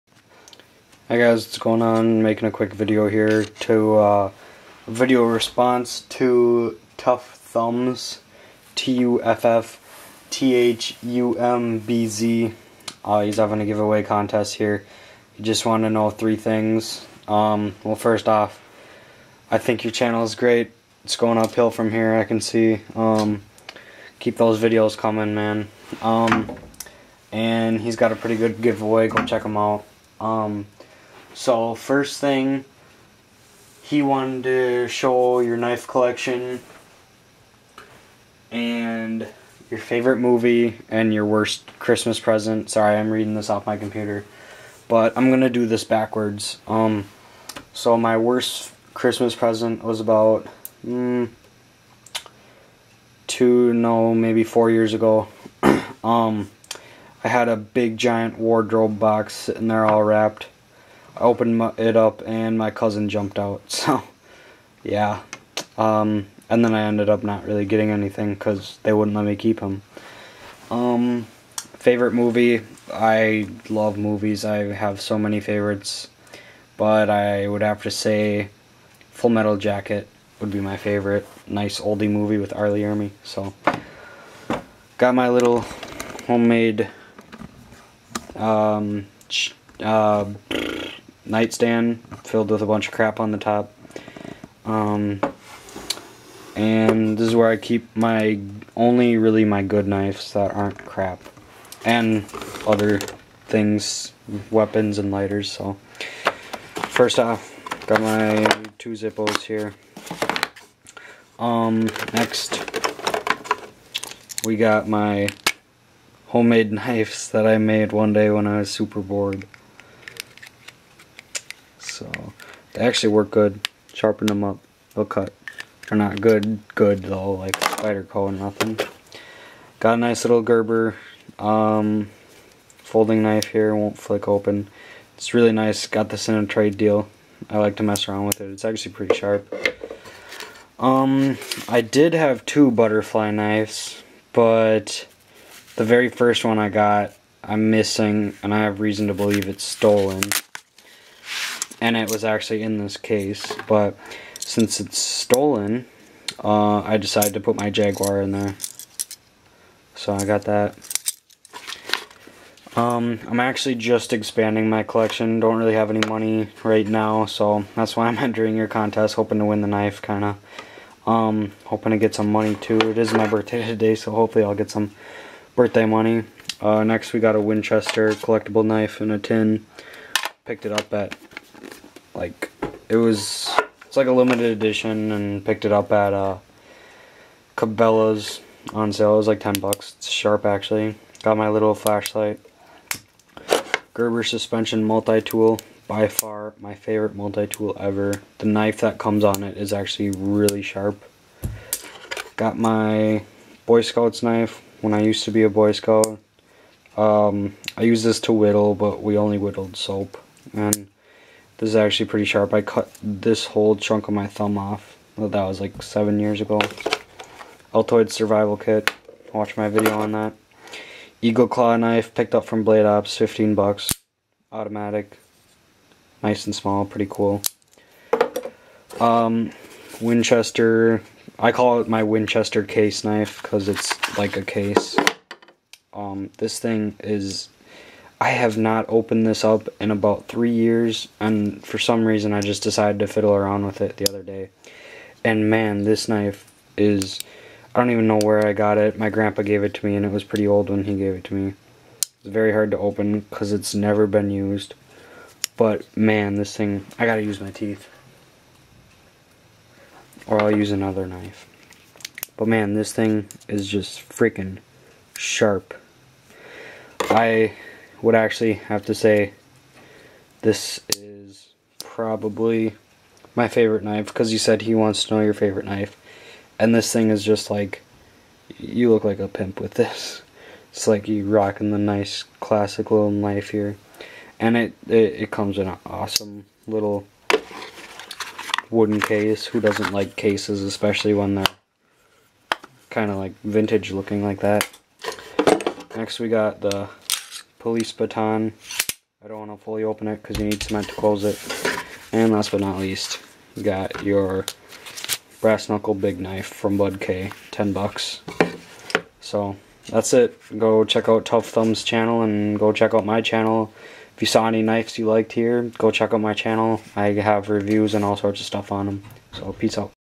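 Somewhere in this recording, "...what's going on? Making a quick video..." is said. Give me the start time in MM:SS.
00:01.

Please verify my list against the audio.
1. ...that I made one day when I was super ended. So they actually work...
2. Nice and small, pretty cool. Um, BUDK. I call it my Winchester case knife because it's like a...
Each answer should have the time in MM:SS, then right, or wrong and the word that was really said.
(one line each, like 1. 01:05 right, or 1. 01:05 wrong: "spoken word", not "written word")
1. 01:57 wrong: "bored", not "ended"
2. 03:46 wrong: "Winchester", not "BUDK".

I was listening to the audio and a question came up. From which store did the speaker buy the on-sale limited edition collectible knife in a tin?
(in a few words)
Cabela's.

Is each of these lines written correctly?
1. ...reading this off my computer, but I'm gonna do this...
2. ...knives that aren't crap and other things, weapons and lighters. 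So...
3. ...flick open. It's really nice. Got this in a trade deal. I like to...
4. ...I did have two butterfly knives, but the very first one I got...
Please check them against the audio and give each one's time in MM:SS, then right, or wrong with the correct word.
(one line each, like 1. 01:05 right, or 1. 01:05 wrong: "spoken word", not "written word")
1. 00:43 right
2. 01:39 right
3. 02:13 right
4. 02:21 right.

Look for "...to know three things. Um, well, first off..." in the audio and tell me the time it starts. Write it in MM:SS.
00:15.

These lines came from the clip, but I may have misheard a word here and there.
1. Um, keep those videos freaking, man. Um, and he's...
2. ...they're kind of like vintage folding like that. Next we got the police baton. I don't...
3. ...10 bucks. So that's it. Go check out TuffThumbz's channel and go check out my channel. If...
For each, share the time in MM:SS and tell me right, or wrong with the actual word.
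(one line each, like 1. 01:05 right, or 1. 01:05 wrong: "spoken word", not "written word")
1. 00:22 wrong: "coming", not "freaking"
2. 04:51 wrong: "looking", not "folding"
3. 05:07 right.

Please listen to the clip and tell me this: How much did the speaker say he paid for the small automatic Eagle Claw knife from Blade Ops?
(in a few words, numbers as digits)
$15.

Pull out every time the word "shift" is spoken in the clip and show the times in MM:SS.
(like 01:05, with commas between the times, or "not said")
not said.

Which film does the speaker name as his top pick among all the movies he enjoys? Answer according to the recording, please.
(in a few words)
Full Metal Jacket.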